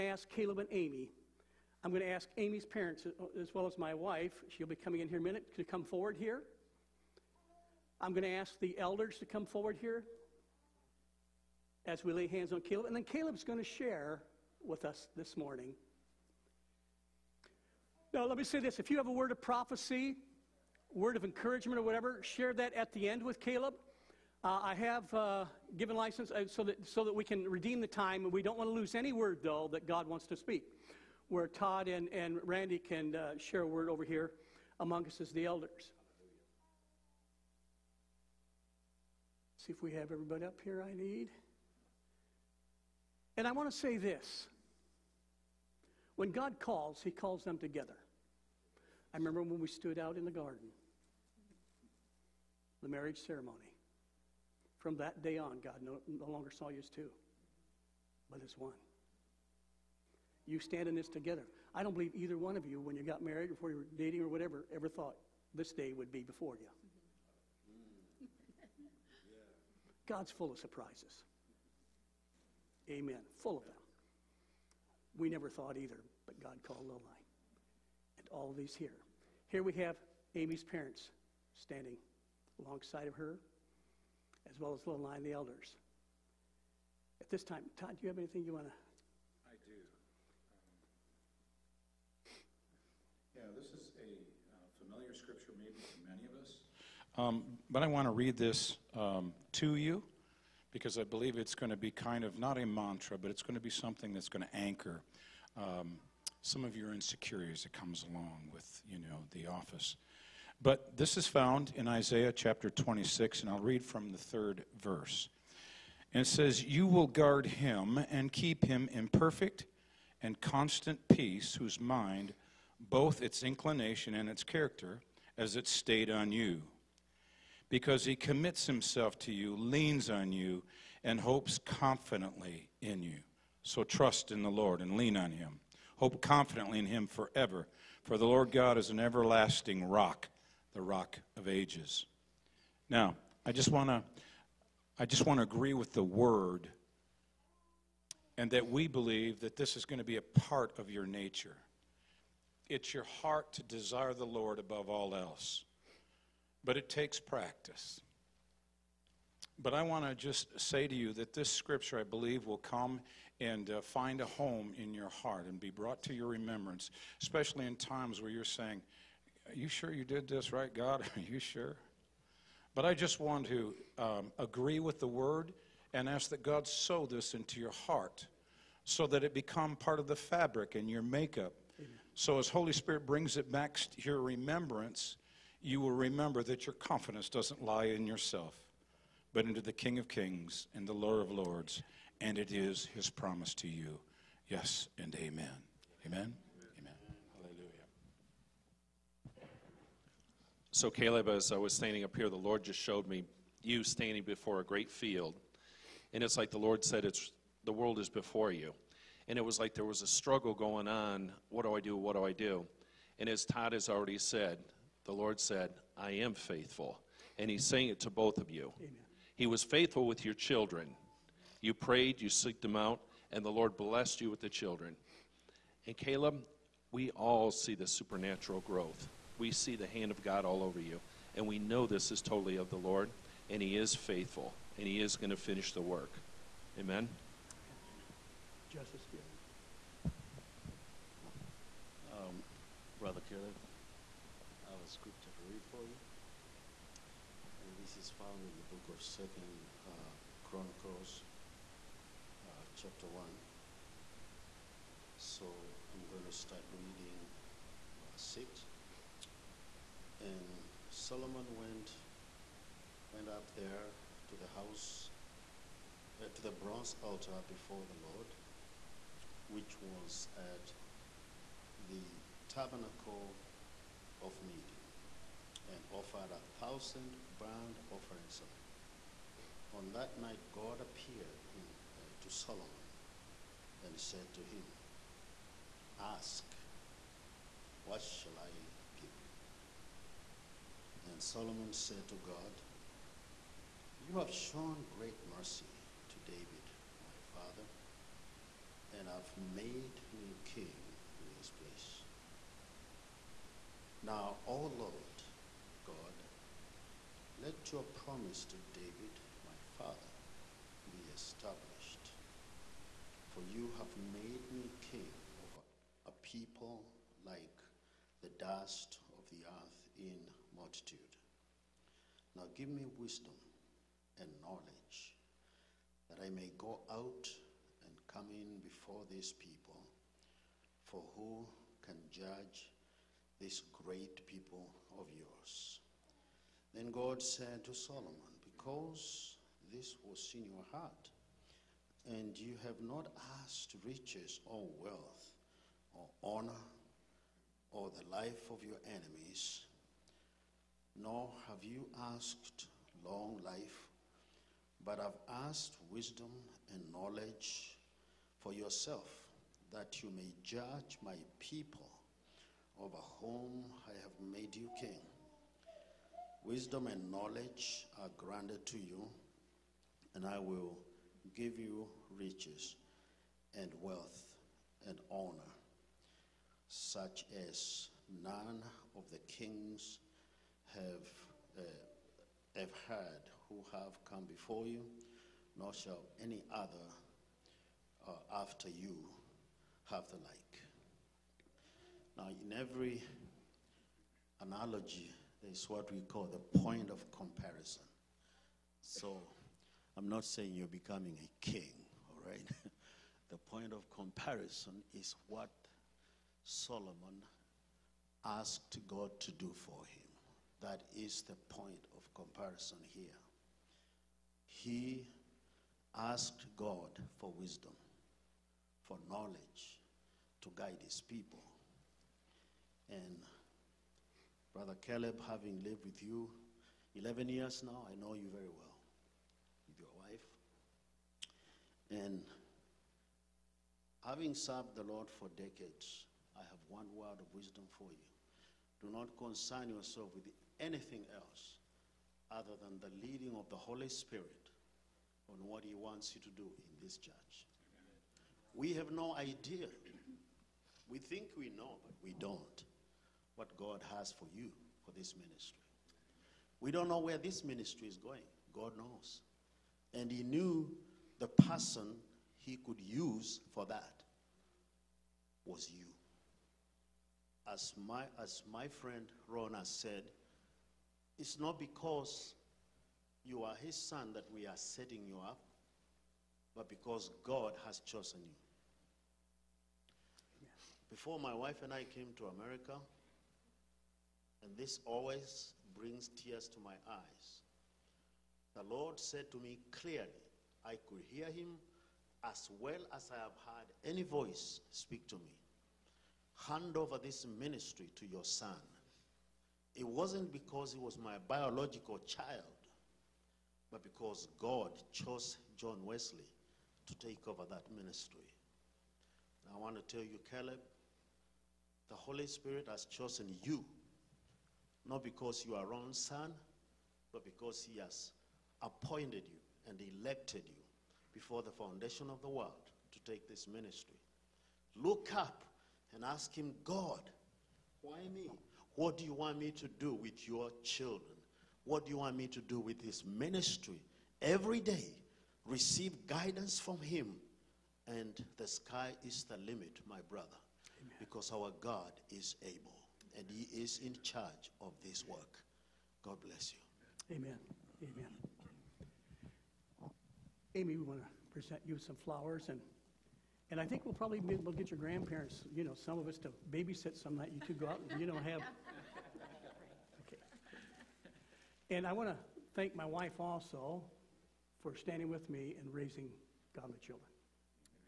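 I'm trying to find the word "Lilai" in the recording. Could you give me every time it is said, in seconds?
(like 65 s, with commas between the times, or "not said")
76 s, 84 s.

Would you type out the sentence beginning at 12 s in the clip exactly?
And then Caleb's going to share with us this morning.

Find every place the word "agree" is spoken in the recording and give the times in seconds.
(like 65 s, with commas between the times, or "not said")
145 s, 174 s.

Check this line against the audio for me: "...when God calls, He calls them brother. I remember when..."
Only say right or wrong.
wrong.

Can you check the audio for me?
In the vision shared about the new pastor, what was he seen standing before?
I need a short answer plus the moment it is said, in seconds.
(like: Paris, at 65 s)
a great field, at 204 s.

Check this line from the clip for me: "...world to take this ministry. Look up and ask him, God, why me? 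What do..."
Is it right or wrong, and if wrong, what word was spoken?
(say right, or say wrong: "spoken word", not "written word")
right.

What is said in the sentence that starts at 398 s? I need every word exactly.
So, I'm not saying you're becoming a king, all right?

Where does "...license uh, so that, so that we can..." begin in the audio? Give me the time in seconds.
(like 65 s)
25 s.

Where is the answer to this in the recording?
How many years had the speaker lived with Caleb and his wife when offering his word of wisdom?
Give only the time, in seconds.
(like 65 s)
426 s.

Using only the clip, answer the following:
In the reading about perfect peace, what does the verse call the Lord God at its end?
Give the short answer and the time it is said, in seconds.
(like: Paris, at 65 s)
the rock of ages, at 140 s.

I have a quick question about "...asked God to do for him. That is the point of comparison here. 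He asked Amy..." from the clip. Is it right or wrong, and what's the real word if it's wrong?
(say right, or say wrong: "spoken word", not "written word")
wrong: "God", not "Amy".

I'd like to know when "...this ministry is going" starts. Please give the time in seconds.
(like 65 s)
457 s.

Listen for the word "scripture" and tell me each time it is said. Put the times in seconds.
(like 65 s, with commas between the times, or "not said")
95 s, 161 s, 244 s.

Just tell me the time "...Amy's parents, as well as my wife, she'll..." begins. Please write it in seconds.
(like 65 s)
2 s.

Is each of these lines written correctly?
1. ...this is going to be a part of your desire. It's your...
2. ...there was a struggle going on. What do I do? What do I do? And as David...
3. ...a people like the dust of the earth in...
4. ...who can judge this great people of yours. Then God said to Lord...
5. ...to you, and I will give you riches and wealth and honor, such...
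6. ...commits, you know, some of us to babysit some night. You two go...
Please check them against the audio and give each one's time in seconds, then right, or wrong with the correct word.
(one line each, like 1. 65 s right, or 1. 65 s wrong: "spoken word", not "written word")
1. 149 s wrong: "nature", not "desire"
2. 209 s wrong: "Todd", not "David"
3. 316 s right
4. 331 s wrong: "Solomon", not "Lord"
5. 368 s right
6. 554 s wrong: "grandparents", not "commits".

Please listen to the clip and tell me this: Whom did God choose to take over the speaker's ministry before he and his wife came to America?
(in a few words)
John Wesley.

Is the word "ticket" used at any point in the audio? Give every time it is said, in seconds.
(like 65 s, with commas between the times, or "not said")
not said.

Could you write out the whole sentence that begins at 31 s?
Where Todd and, and Randy can uh, share a word over here among us as the elders.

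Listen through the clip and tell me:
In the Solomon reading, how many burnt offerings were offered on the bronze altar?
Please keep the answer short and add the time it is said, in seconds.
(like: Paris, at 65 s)
1000, at 276 s.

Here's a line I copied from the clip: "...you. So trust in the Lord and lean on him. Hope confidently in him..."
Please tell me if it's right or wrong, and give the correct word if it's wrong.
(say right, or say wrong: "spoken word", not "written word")
right.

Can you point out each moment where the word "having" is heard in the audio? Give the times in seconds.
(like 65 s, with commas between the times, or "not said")
425 s, 434 s.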